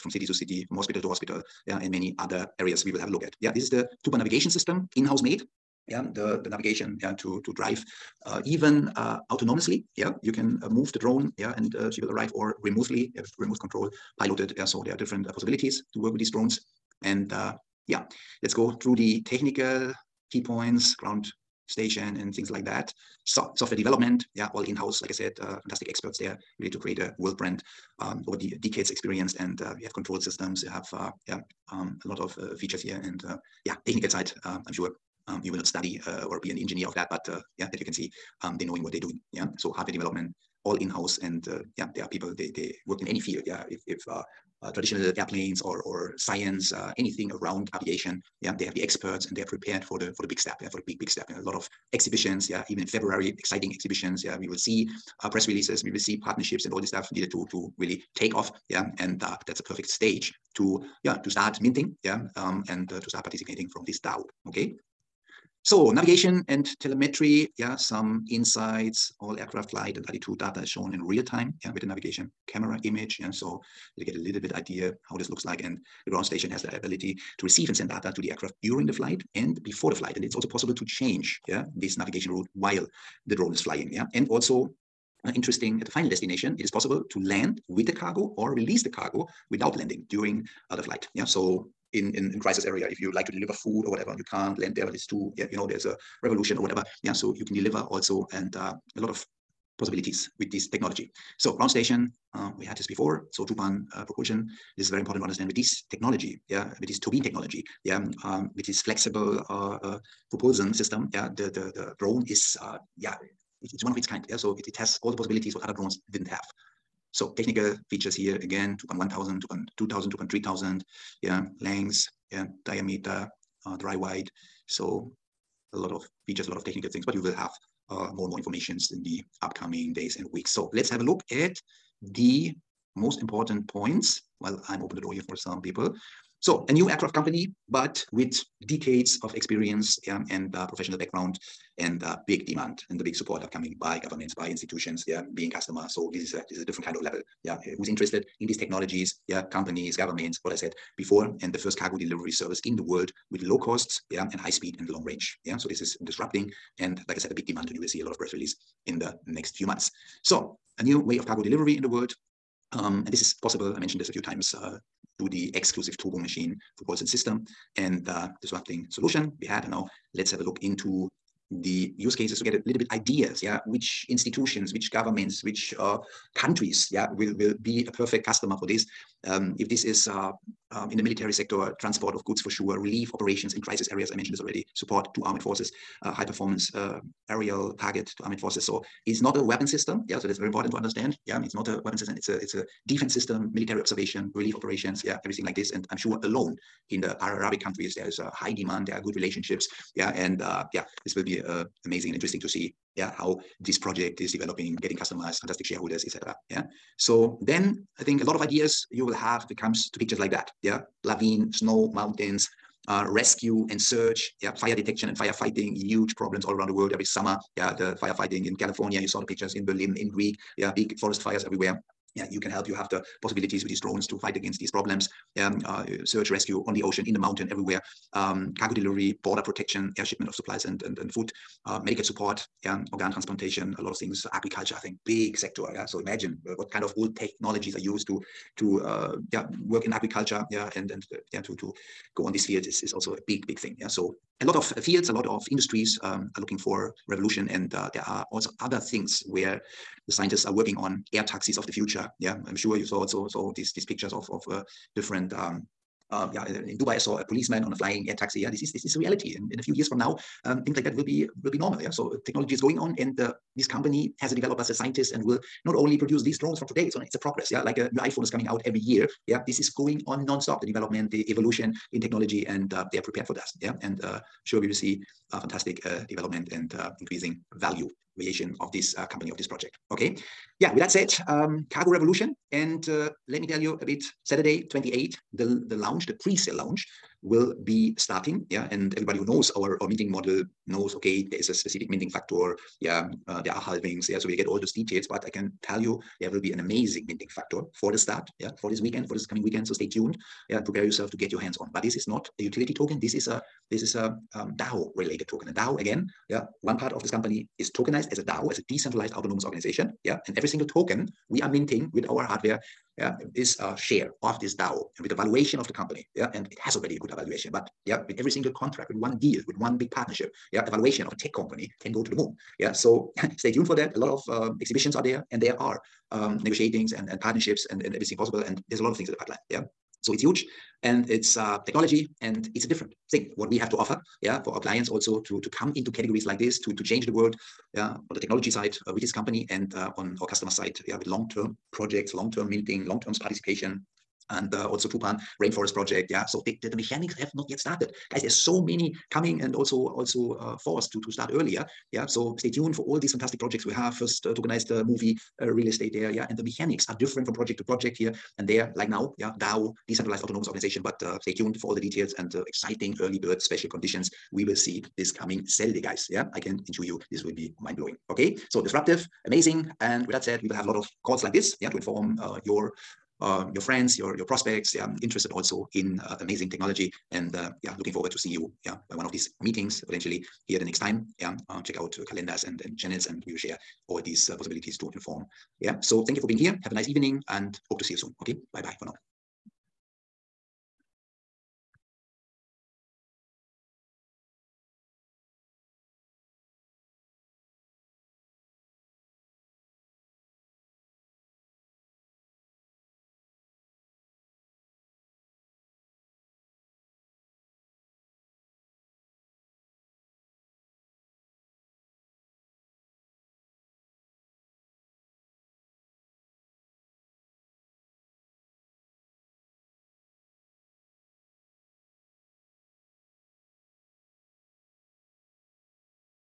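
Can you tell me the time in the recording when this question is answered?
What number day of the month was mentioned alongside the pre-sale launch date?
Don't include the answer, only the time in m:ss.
4:44.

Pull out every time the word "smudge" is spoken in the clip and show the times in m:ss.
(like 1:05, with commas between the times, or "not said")
not said.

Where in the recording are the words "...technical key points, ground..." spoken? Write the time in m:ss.
0:19.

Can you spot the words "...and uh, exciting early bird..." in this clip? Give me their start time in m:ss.
6:02.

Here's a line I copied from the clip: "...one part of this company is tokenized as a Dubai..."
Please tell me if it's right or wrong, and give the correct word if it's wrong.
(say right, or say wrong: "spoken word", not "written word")
wrong: "DAO", not "Dubai".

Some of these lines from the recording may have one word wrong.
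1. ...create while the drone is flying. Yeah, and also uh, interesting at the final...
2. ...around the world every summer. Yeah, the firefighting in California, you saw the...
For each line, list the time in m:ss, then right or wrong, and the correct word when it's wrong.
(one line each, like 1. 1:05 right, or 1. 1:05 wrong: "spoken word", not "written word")
1. 1:22 wrong: "route", not "create"
2. 3:36 right.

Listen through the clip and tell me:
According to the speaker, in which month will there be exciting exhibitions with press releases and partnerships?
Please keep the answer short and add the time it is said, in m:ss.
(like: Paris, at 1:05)
February, at 0:52.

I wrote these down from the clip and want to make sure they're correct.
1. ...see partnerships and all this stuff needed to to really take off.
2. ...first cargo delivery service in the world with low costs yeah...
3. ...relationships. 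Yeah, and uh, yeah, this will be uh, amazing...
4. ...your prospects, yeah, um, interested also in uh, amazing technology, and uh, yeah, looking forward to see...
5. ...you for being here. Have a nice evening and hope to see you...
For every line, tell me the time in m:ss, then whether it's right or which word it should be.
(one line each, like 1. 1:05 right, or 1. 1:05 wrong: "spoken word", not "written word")
1. 0:55 right
2. 2:31 right
3. 3:19 right
4. 6:14 right
5. 6:26 right.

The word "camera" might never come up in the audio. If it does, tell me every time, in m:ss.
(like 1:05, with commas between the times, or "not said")
1:12.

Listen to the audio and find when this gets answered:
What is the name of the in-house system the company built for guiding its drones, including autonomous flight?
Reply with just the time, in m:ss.
0:04.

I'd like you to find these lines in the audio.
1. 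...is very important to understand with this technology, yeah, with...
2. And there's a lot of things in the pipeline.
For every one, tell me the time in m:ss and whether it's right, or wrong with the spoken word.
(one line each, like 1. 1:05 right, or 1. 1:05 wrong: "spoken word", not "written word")
1. 1:44 right
2. 5:28 right.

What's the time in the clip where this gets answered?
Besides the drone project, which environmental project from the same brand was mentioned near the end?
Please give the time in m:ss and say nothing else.
5:44.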